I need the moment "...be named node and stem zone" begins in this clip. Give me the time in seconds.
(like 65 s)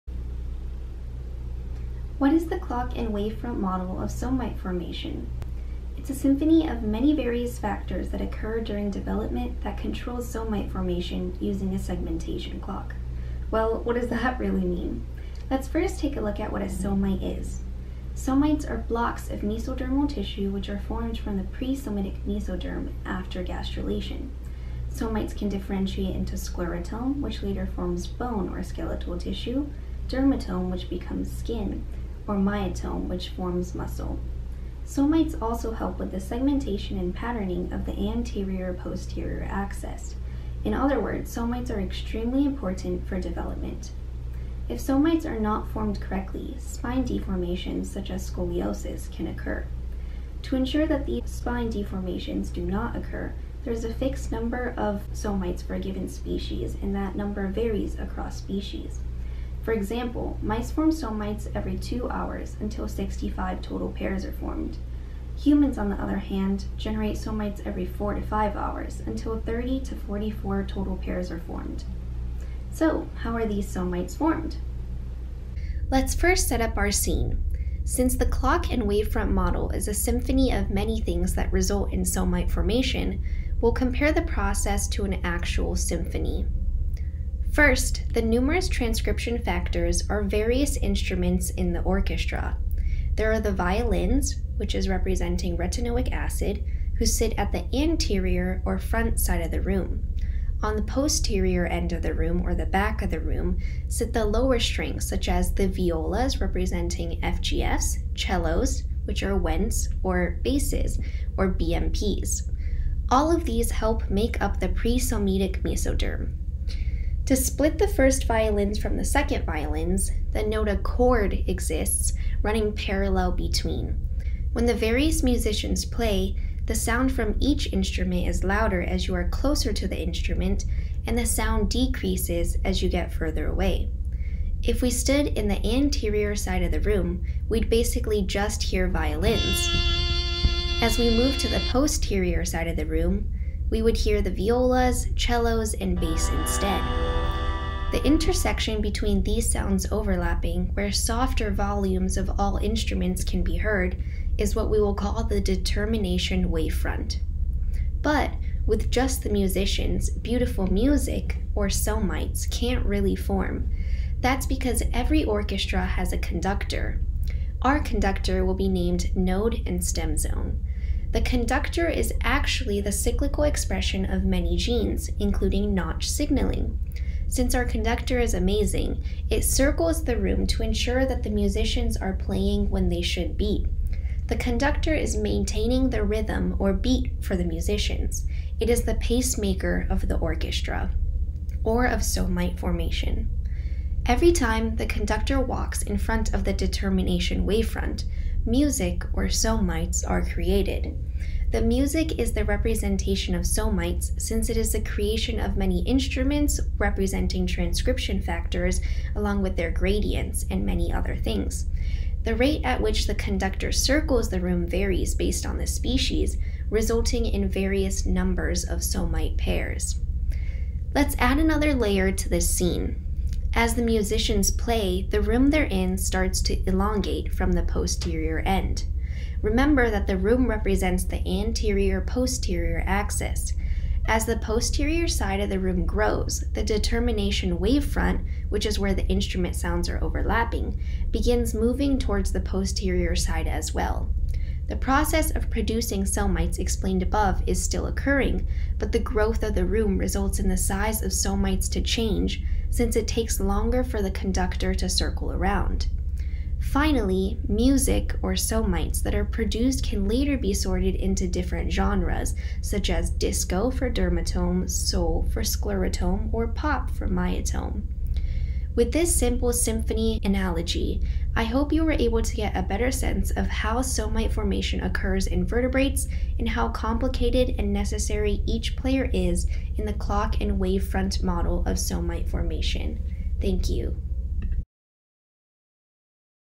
168 s.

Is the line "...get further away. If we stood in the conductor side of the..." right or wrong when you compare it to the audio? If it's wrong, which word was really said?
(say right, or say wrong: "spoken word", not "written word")
wrong: "anterior", not "conductor".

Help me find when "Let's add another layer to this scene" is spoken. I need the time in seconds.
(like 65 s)
220 s.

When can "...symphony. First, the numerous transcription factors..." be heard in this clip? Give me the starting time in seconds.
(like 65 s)
85 s.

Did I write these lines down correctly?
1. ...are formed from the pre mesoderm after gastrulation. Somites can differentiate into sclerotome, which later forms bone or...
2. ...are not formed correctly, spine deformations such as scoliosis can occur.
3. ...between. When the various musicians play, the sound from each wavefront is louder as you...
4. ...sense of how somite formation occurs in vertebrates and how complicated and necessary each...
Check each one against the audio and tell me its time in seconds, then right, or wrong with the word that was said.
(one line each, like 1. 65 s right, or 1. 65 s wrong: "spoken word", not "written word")
1. 20 s right
2. 45 s right
3. 123 s wrong: "instrument", not "wavefront"
4. 272 s right.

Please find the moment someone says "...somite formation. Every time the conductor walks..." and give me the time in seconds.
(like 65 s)
192 s.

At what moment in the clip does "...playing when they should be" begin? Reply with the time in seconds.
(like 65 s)
182 s.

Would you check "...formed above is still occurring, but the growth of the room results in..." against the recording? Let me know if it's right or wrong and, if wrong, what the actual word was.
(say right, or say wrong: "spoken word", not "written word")
wrong: "explained", not "formed".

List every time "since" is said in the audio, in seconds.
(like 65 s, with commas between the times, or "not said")
77 s, 177 s, 204 s, 252 s.